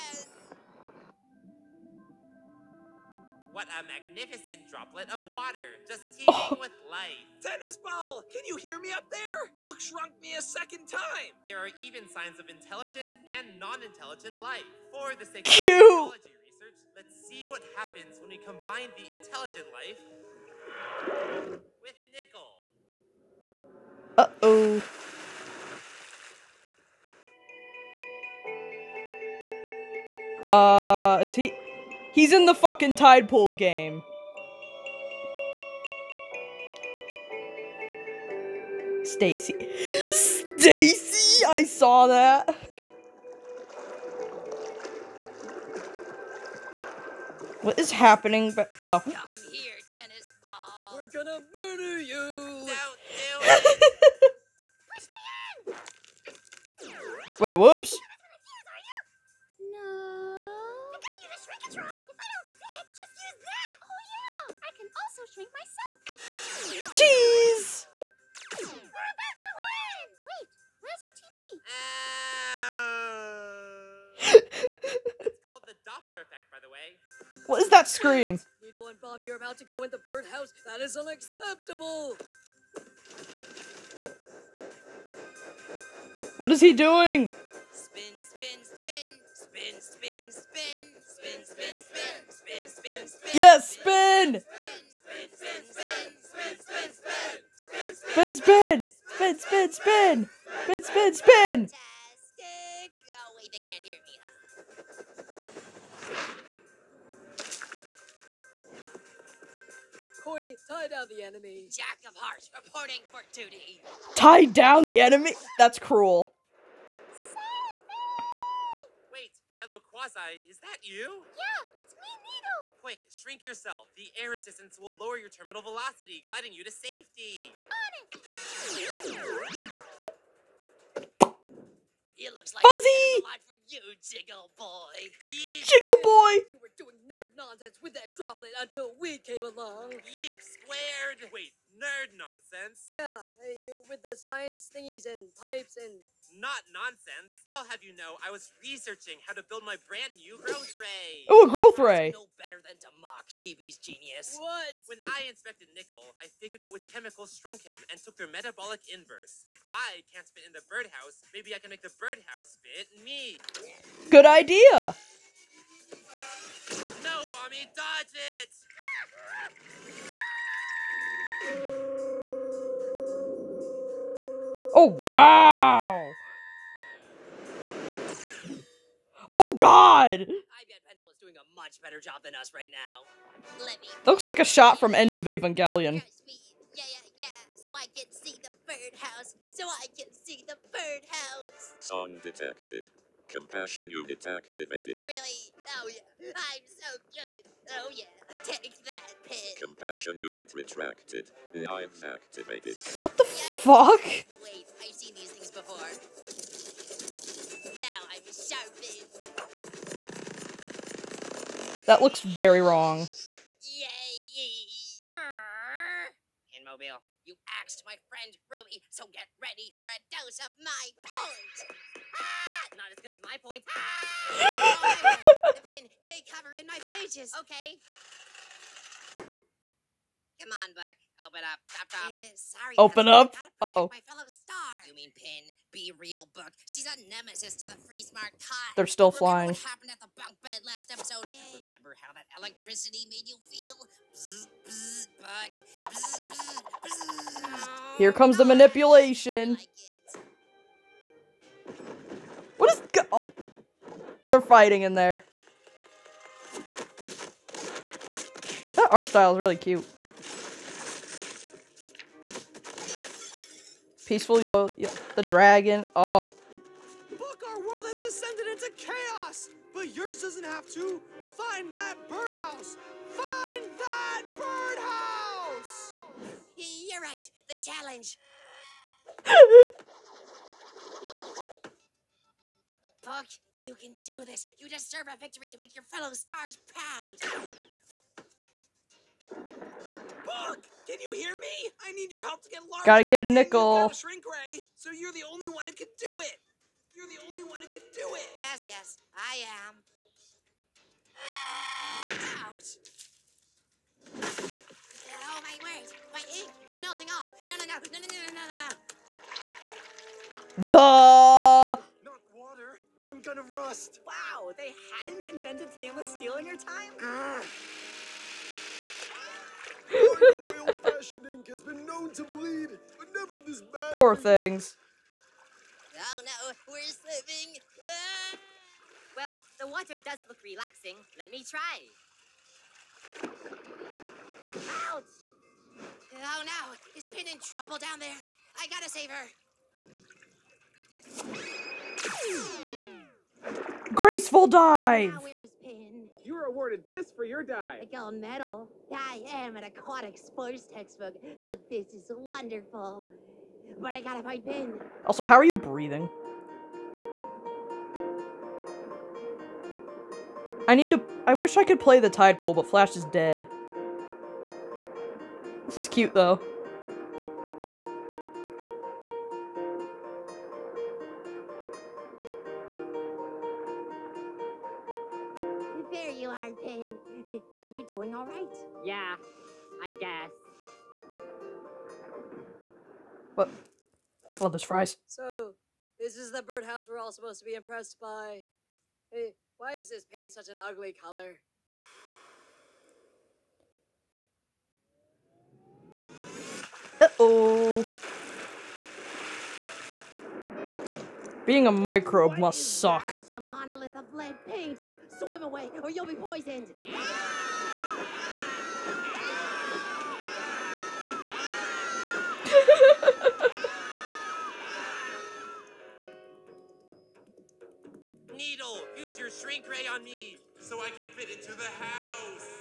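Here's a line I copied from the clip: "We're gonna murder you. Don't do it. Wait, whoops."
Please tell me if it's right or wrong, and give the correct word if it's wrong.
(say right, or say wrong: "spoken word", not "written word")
right.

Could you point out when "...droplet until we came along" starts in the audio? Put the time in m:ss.
2:18.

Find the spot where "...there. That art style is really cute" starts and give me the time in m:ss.
4:14.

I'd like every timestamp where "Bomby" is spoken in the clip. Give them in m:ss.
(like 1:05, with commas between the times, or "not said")
1:18, 2:47.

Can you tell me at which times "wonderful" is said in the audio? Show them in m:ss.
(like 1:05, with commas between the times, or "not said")
5:52.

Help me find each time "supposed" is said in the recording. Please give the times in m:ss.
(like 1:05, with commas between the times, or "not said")
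6:27.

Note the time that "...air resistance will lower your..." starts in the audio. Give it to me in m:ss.
2:04.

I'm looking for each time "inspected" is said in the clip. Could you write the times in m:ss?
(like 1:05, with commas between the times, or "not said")
2:35.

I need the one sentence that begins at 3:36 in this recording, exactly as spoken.
In Mobile, you axed my friend Ruby, so get ready for a dose of my point.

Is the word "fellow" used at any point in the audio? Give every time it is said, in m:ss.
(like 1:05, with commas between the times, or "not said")
1:59, 3:54, 4:45.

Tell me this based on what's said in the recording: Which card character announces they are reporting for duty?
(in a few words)
Jack of Hearts.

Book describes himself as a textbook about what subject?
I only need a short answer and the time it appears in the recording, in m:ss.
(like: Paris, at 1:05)
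Aquatic sports, at 5:49.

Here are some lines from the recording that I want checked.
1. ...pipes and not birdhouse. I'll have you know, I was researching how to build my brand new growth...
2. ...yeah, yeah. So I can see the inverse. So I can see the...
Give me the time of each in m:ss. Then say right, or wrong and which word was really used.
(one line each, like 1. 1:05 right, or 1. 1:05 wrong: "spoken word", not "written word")
1. 2:25 wrong: "nonsense", not "birdhouse"
2. 3:06 wrong: "birdhouse", not "inverse".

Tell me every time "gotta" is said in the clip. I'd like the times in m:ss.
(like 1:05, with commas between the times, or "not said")
4:52, 5:38, 5:53.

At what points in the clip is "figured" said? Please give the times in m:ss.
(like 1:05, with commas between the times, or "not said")
2:36.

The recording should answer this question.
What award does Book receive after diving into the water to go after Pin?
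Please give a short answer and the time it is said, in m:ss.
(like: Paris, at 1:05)
Gold medal, at 5:47.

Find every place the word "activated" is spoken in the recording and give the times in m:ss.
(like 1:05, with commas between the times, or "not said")
3:14, 3:22.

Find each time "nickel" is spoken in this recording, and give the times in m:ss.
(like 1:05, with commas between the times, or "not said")
0:22, 2:35, 4:53.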